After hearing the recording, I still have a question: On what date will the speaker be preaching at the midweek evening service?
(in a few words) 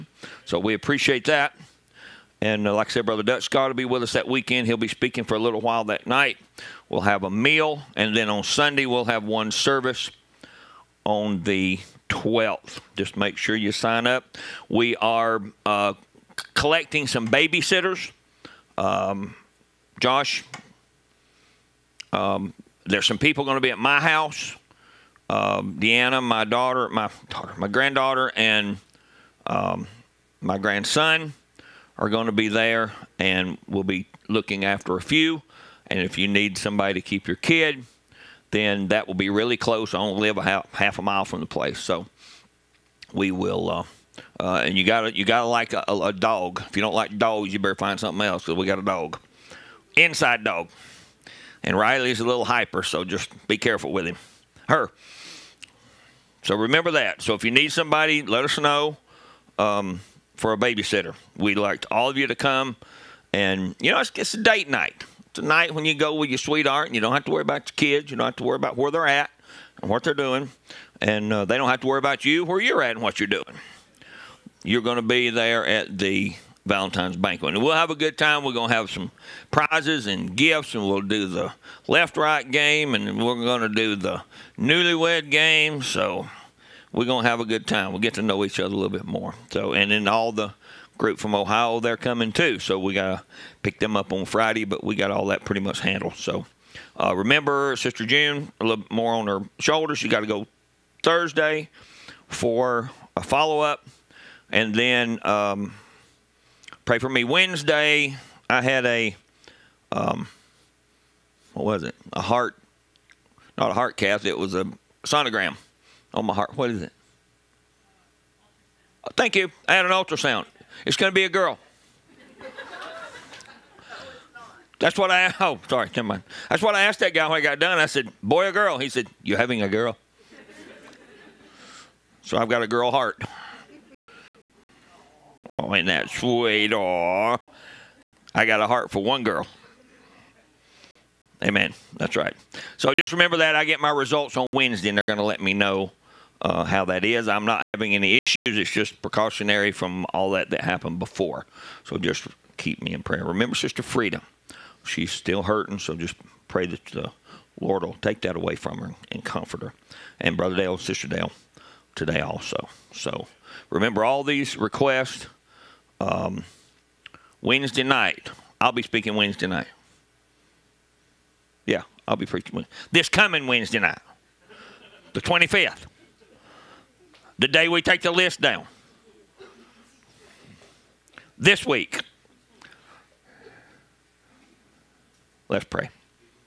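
25th.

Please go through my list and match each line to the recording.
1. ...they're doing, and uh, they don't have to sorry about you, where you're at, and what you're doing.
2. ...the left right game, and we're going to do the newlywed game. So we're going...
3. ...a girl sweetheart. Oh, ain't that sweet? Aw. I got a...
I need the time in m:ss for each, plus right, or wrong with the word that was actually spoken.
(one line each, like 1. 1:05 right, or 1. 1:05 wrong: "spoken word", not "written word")
1. 1:10 wrong: "worry", not "sorry"
2. 1:21 right
3. 2:12 wrong: "heart", not "sweetheart".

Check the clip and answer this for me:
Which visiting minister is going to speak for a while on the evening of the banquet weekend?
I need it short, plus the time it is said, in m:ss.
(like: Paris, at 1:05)
Dutch Scott, at 0:03.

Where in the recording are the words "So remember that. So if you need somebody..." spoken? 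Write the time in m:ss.
0:56.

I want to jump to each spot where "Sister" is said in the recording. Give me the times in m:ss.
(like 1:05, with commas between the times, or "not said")
1:37, 2:33, 2:40.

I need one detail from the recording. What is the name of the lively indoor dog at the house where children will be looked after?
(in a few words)
Riley.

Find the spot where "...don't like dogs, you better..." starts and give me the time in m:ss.
0:46.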